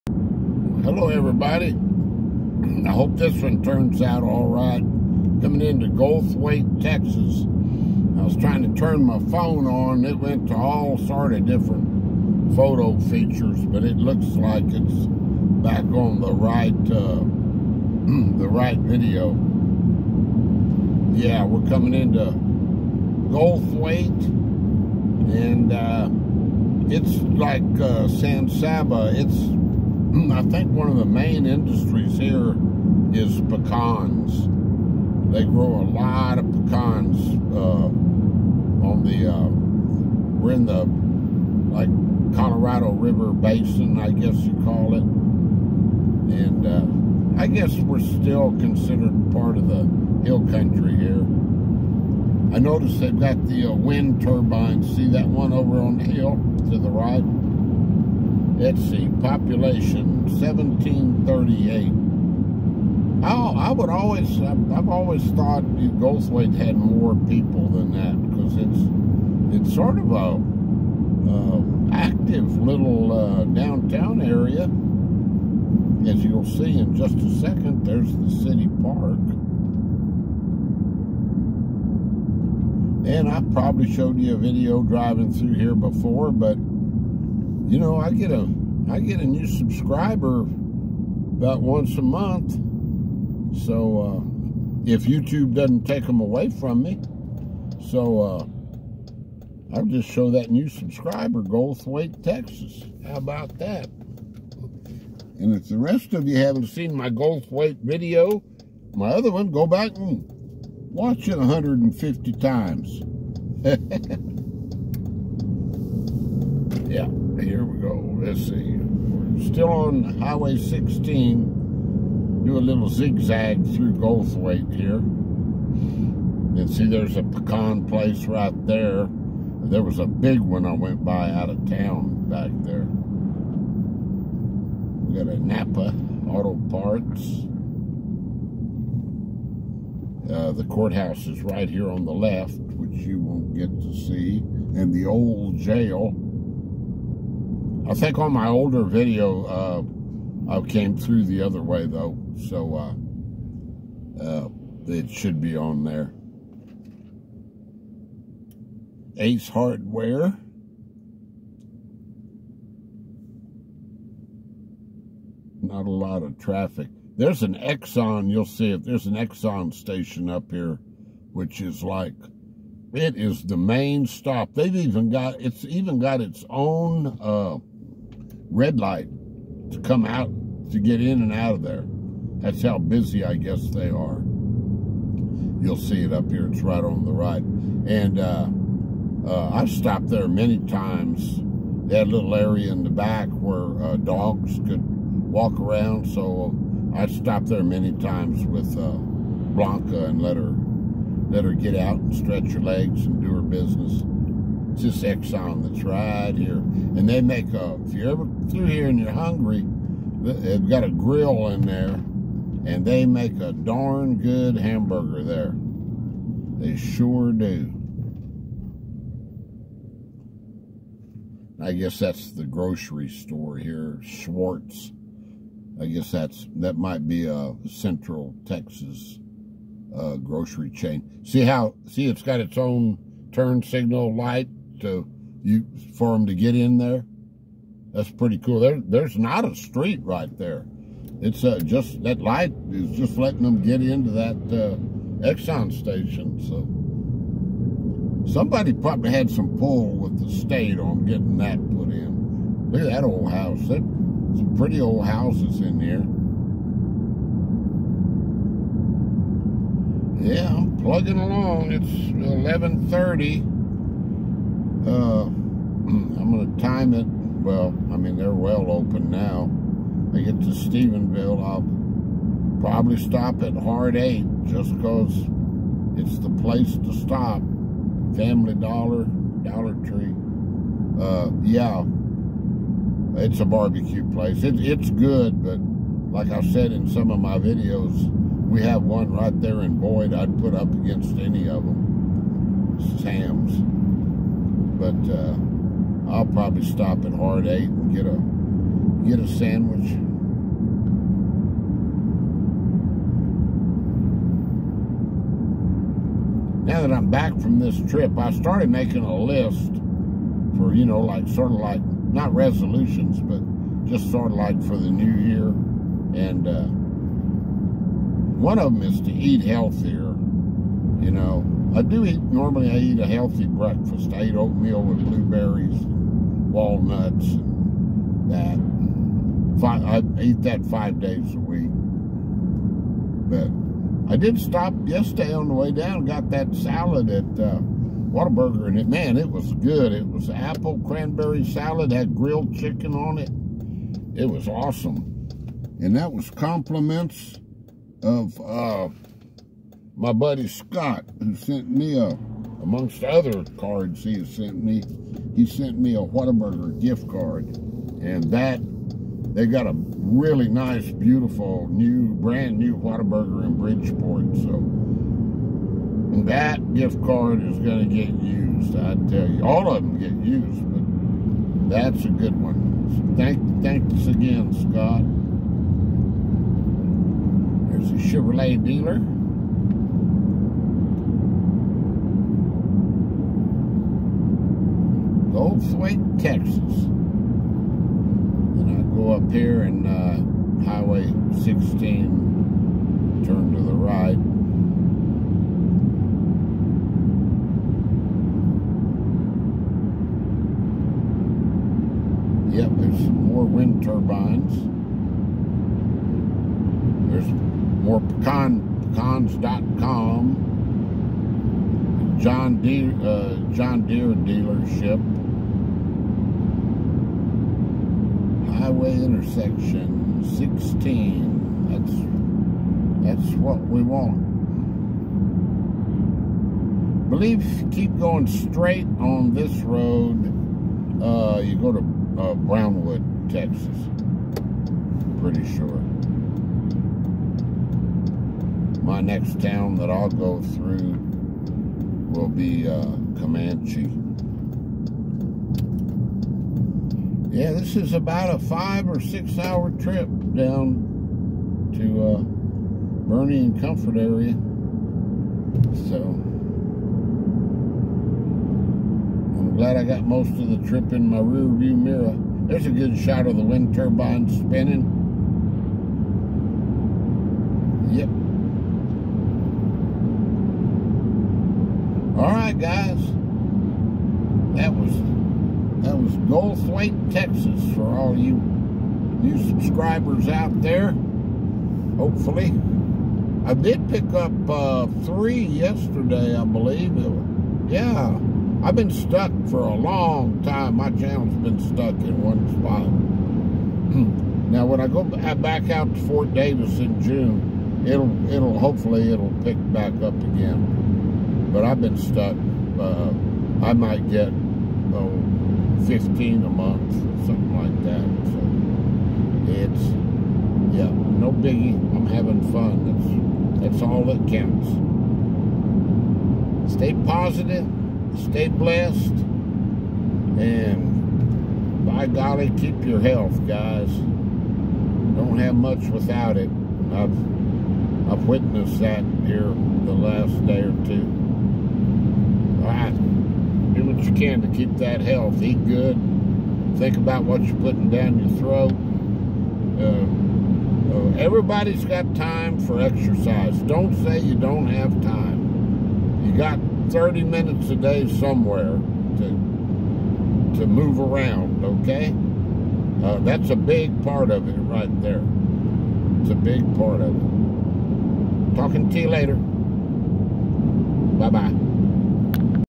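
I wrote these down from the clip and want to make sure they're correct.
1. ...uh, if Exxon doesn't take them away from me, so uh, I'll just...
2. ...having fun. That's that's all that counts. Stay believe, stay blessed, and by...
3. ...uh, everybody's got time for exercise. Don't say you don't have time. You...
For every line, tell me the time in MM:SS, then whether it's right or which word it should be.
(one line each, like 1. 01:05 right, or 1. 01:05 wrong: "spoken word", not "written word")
1. 01:34 wrong: "YouTube", not "Exxon"
2. 08:32 wrong: "positive", not "believe"
3. 09:00 right.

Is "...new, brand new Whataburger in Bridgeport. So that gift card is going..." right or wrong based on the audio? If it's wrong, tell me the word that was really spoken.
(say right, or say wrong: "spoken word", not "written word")
right.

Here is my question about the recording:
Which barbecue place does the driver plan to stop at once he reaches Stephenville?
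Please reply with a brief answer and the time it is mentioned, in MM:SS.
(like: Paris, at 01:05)
Hard 8, at 04:33.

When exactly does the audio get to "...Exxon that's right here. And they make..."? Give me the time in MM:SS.
03:25.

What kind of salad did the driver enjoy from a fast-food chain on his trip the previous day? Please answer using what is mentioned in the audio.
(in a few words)
Apple cranberry salad.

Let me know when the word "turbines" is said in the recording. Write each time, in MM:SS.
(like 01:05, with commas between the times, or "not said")
00:54, 06:43, 07:43.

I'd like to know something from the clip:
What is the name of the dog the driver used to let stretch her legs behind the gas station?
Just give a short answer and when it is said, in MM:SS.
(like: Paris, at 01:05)
Blanca, at 03:19.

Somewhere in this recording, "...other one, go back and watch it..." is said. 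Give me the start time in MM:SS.
01:49.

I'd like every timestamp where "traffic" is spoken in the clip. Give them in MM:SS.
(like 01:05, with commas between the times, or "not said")
02:46.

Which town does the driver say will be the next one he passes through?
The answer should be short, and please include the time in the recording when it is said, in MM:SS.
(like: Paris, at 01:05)
Comanche, at 07:23.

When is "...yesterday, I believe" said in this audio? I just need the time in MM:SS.
08:05.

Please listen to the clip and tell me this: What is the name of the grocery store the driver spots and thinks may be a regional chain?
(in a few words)
Schwartz.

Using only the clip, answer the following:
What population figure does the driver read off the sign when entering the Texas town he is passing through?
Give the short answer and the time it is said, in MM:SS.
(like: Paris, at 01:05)
1738, at 01:00.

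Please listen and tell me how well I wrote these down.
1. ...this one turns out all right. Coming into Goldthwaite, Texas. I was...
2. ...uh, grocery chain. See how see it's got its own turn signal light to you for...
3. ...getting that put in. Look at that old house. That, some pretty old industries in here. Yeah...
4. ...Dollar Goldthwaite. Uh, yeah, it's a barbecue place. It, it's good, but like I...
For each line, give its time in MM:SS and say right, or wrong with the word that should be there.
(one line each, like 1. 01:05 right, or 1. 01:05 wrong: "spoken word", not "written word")
1. 00:03 right
2. 03:49 right
3. 04:11 wrong: "houses", not "industries"
4. 04:39 wrong: "Tree", not "Goldthwaite".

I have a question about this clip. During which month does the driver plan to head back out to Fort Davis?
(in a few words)
June.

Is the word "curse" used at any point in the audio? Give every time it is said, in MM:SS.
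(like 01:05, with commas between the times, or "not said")
not said.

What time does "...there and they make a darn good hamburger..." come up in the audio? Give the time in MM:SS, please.
03:31.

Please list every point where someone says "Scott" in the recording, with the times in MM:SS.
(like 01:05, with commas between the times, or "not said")
05:50, 06:14.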